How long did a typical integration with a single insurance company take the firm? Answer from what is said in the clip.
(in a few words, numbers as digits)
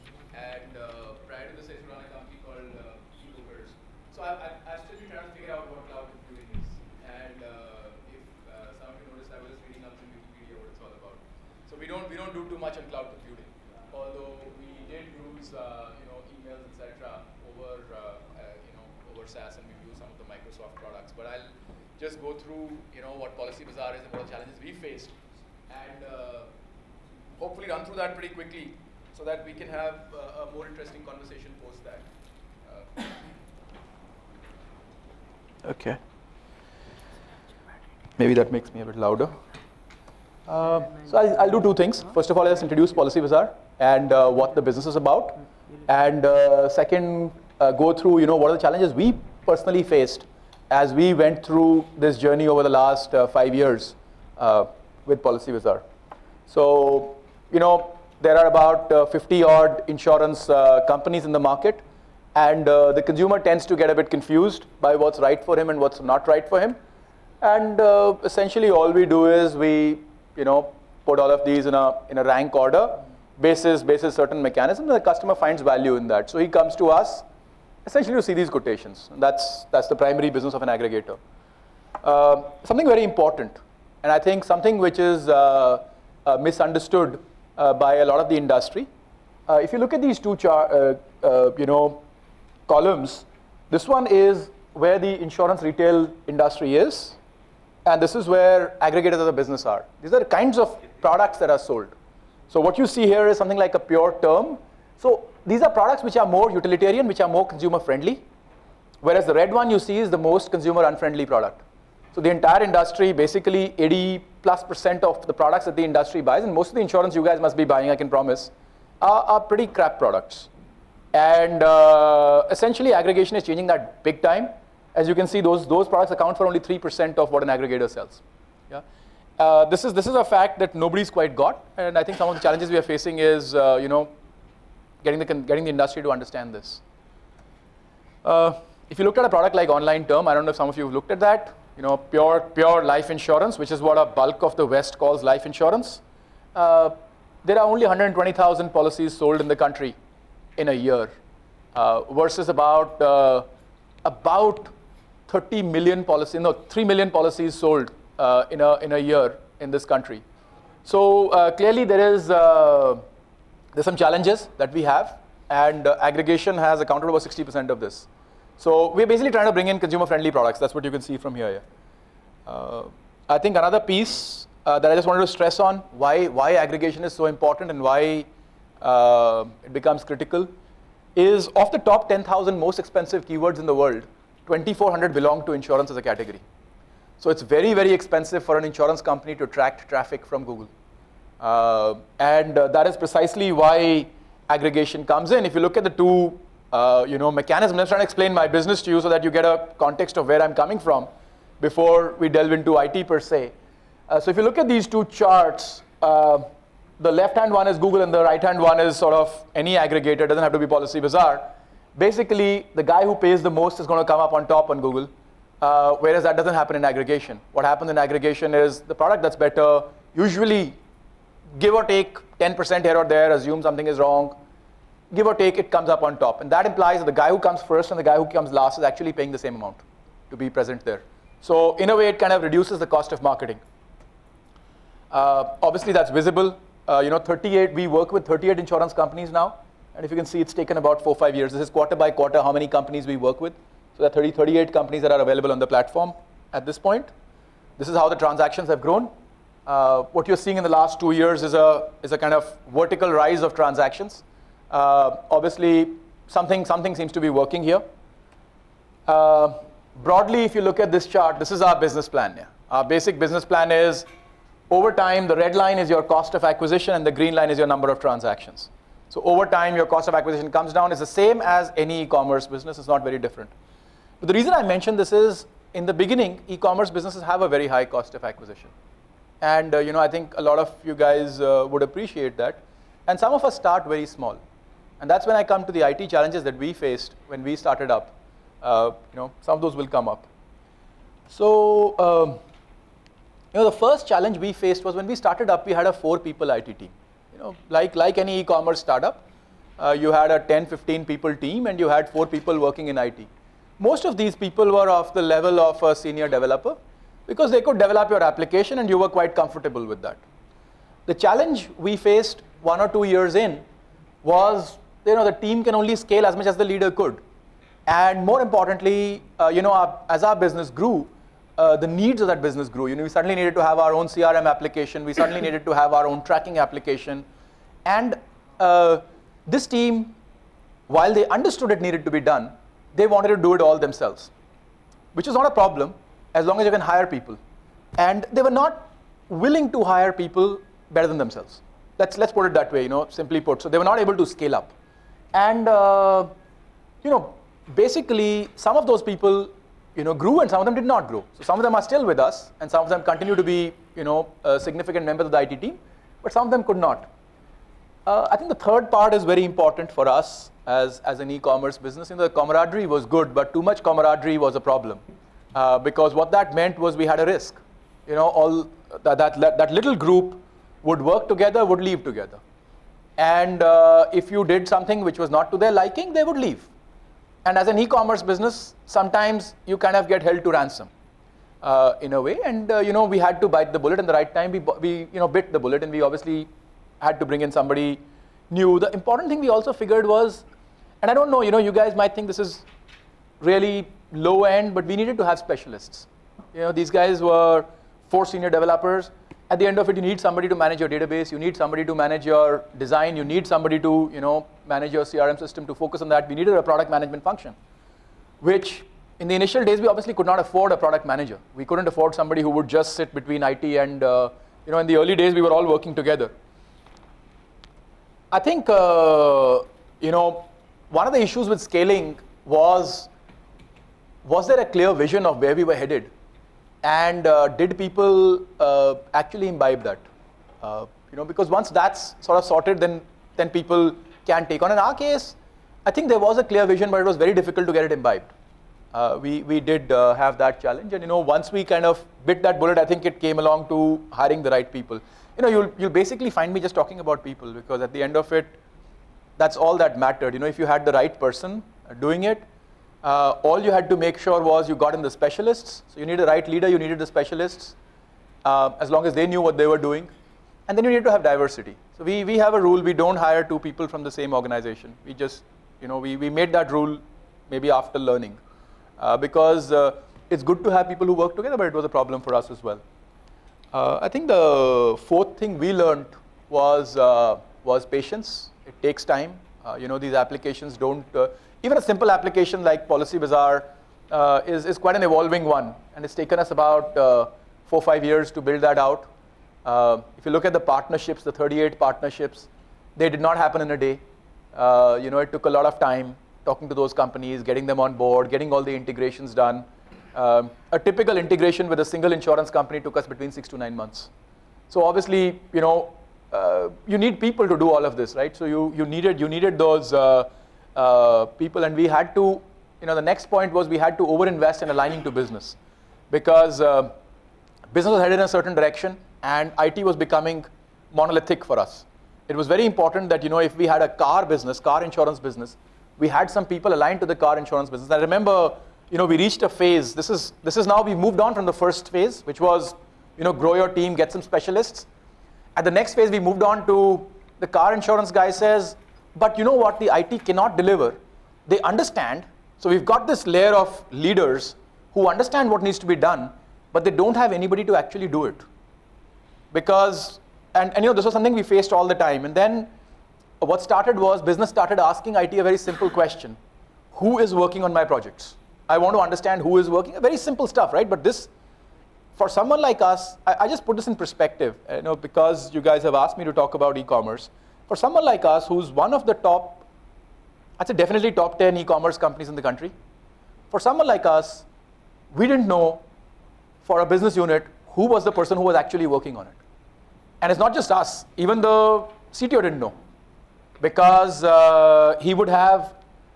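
6 to 9 months.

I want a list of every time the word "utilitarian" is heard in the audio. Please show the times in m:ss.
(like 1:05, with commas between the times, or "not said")
1:46.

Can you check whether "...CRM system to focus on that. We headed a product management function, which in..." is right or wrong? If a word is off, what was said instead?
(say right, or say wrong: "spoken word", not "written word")
wrong: "needed", not "headed".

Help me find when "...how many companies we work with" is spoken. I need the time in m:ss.
4:02.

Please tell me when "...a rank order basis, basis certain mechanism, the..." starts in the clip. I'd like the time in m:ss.
1:12.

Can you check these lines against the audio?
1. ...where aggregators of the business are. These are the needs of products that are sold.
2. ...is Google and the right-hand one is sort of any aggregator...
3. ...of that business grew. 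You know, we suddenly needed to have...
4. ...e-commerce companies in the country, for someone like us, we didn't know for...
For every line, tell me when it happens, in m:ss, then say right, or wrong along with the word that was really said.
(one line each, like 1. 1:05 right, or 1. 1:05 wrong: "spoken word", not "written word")
1. 1:38 wrong: "kinds", not "needs"
2. 3:27 right
3. 5:22 right
4. 9:31 right.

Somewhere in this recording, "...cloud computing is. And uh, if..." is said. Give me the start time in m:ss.
0:05.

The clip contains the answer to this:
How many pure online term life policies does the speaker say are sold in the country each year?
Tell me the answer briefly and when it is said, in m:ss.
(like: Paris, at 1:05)
120,000, at 2:27.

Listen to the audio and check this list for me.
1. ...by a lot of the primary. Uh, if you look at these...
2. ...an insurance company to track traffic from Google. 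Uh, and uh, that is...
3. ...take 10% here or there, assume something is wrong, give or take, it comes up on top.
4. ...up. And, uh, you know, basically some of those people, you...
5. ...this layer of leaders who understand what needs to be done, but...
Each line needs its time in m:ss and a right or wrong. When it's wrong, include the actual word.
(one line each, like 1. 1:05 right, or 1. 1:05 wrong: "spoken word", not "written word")
1. 1:27 wrong: "industry", not "primary"
2. 3:08 right
3. 3:41 right
4. 5:44 right
5. 9:03 right.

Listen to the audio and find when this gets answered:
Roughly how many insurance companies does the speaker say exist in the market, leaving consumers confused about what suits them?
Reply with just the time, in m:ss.
0:59.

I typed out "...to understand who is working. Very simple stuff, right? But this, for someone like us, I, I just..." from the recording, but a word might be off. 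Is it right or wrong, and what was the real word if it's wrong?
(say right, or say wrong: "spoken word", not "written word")
right.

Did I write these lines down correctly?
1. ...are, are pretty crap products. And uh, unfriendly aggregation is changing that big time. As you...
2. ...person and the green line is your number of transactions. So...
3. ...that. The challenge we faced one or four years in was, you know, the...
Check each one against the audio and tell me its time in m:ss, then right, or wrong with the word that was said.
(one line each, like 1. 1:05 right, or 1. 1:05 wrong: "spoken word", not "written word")
1. 1:59 wrong: "essentially", not "unfriendly"
2. 4:26 wrong: "acquisition", not "person"
3. 5:10 wrong: "two", not "four".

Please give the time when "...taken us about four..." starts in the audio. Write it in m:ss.
8:06.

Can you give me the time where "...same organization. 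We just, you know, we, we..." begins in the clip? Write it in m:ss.
7:44.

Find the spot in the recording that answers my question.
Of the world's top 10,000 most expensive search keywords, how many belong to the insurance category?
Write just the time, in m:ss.
3:04.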